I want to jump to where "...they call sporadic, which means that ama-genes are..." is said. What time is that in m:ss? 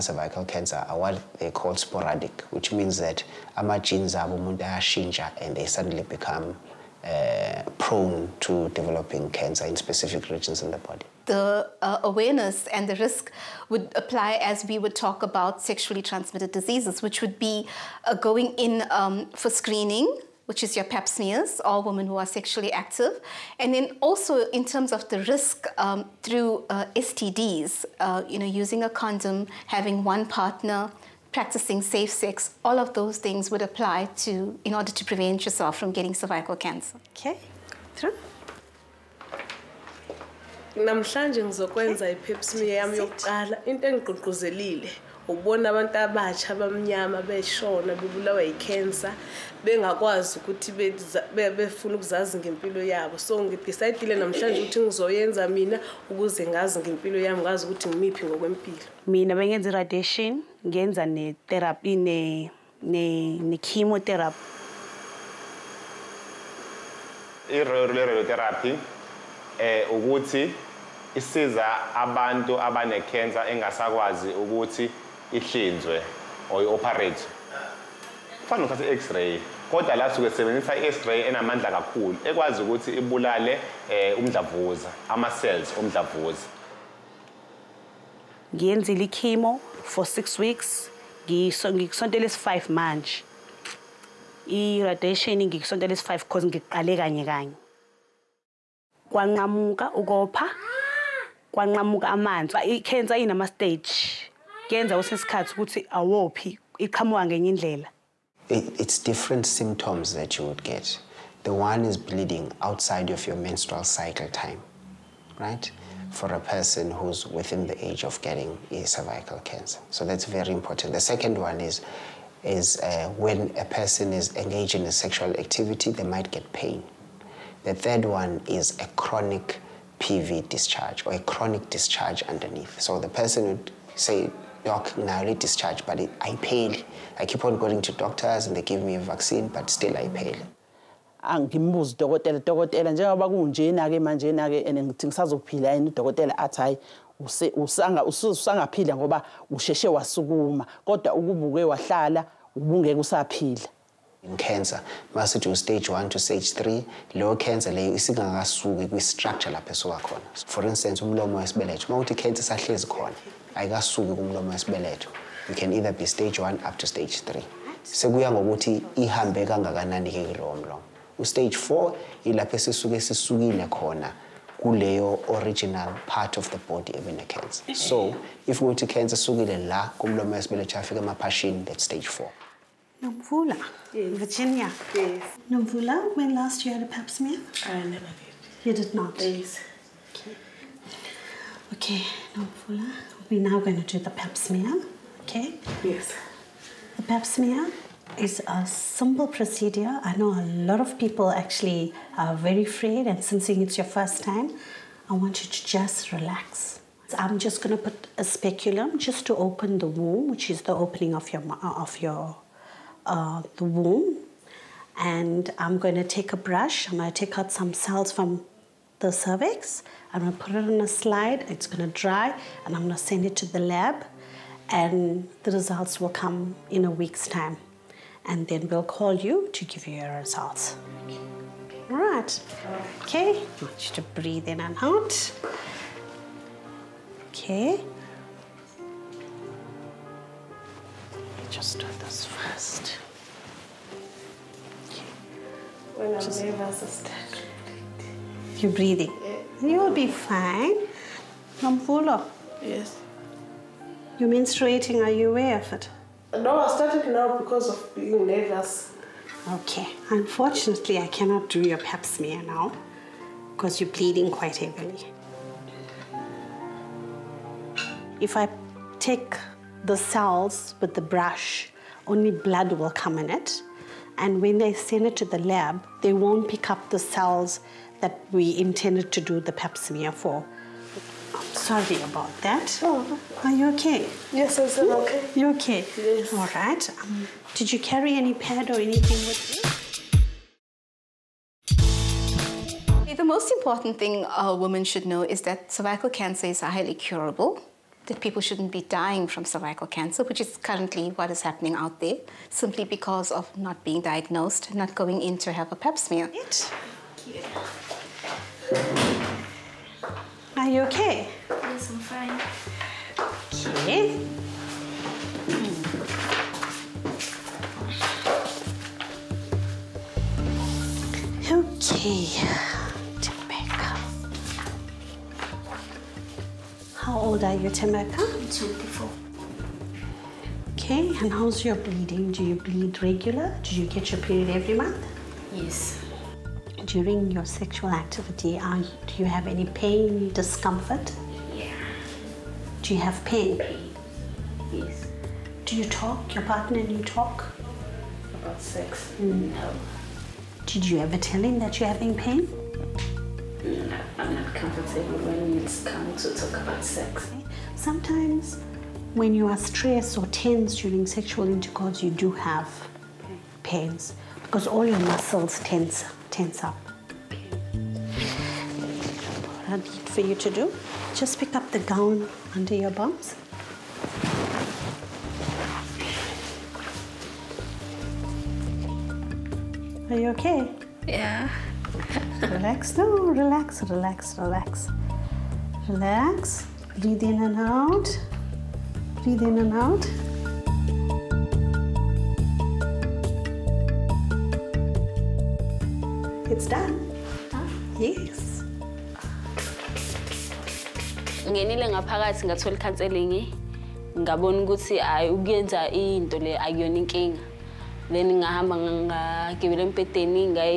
0:01.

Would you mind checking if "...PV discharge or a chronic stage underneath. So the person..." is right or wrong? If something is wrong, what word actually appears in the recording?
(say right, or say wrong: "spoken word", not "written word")
wrong: "discharge", not "stage".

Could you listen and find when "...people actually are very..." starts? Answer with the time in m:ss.
3:20.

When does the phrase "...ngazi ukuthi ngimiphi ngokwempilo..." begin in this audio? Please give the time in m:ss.
0:57.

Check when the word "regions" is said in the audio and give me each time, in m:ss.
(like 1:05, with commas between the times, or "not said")
0:10.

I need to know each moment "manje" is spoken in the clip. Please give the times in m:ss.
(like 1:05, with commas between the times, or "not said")
1:32, 2:23.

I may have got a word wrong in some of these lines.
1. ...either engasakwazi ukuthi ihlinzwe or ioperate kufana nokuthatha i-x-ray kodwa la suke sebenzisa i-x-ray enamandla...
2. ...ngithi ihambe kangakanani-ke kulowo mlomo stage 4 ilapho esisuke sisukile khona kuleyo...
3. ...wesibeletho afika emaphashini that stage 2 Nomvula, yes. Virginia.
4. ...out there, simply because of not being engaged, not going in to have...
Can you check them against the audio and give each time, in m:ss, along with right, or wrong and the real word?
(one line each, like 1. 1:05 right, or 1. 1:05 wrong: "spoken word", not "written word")
1. 1:12 wrong: "abanecancer", not "either"
2. 2:48 wrong: "ngokuthi", not "ngithi"
3. 3:00 wrong: "4", not "2"
4. 5:01 wrong: "diagnosed", not "engaged".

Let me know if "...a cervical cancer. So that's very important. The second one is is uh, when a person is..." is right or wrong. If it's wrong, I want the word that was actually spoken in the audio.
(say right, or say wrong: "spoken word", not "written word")
right.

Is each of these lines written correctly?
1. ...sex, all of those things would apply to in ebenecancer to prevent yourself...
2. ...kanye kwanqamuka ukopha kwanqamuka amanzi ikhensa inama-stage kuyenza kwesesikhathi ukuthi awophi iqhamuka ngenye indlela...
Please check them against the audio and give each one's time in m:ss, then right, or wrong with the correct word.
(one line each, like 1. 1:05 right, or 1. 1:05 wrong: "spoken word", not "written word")
1. 0:32 wrong: "order", not "ebenecancer"
2. 1:37 right.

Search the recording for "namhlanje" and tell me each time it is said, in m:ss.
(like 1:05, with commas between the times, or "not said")
0:40, 0:54.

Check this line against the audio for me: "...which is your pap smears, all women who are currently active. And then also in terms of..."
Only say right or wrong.
wrong.